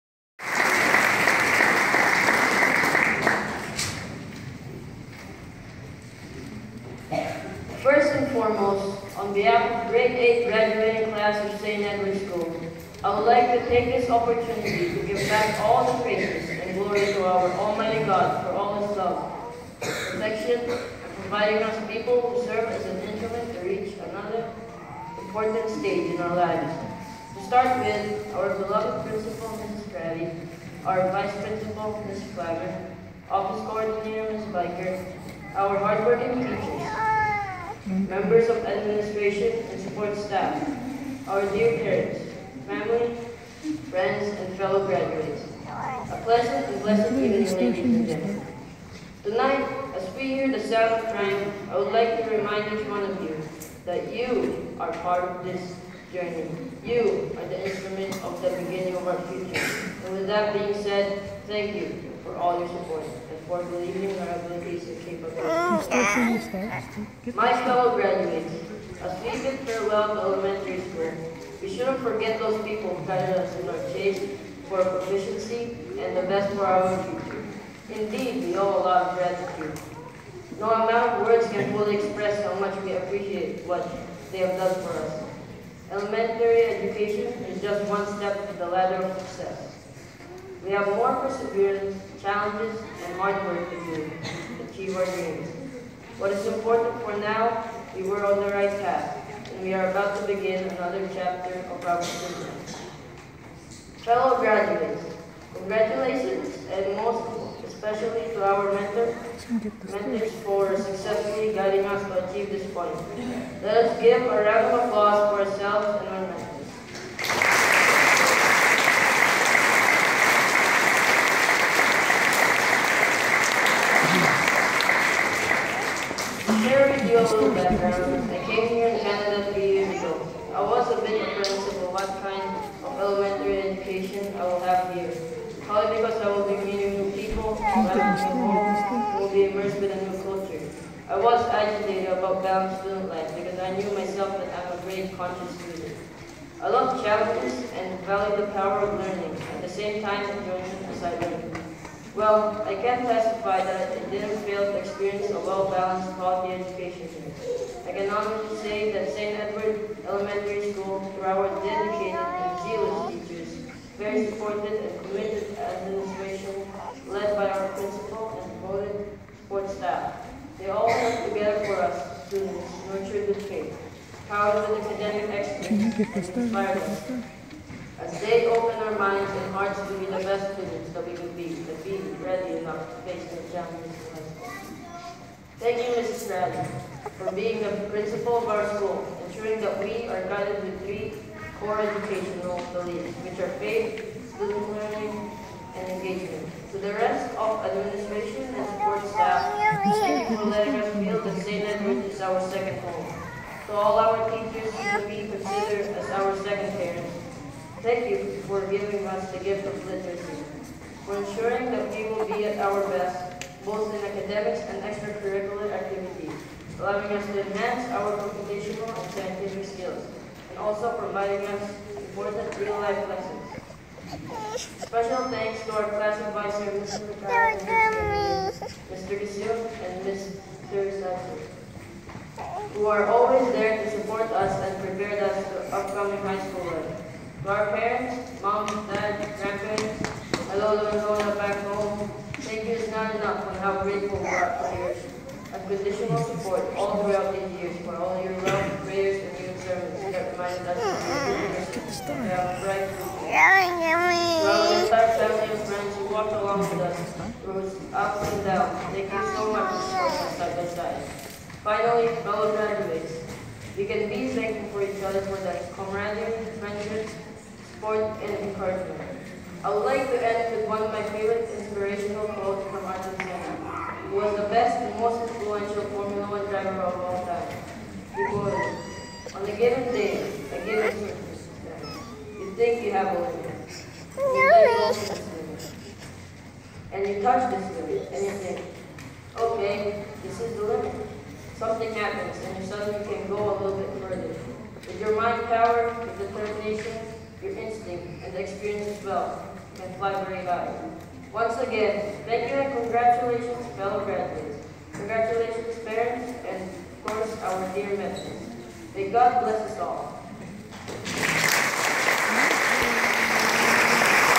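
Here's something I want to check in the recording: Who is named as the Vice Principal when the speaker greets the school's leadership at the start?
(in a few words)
Ms. Flagger.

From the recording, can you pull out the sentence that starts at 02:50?
They all work together for us, students, nurtured with faith, powered with academic excellence, inspired us.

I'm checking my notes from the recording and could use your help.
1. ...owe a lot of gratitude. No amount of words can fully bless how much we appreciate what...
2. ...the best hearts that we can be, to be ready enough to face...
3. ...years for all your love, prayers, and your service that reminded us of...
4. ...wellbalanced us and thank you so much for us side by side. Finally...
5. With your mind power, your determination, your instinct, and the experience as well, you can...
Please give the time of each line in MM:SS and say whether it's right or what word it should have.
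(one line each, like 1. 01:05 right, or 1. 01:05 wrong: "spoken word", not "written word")
1. 01:18 wrong: "express", not "bless"
2. 03:00 wrong: "students", not "hearts"
3. 04:07 right
4. 04:16 wrong: "walked", not "wellbalanced"
5. 04:54 right.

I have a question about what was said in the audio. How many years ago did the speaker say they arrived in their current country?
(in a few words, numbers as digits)
3.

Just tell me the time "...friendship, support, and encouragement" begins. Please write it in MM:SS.
04:26.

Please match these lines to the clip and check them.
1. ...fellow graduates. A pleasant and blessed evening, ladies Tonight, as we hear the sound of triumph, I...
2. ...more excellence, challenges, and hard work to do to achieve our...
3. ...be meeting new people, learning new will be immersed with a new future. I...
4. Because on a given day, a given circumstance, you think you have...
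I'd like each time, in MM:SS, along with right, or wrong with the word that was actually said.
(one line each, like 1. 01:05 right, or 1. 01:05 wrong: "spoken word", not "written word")
1. 00:44 right
2. 01:30 wrong: "perseverance", not "excellence"
3. 02:16 wrong: "culture", not "future"
4. 04:38 right.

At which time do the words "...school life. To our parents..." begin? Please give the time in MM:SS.
03:56.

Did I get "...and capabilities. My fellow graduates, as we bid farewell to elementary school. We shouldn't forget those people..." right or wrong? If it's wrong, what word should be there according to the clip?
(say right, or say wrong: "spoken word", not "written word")
right.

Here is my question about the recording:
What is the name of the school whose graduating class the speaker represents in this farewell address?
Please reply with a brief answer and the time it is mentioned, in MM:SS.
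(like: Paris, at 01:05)
St. Edward School, at 00:11.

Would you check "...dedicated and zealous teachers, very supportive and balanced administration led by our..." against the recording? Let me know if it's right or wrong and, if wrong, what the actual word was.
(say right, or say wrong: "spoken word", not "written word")
wrong: "committed", not "balanced".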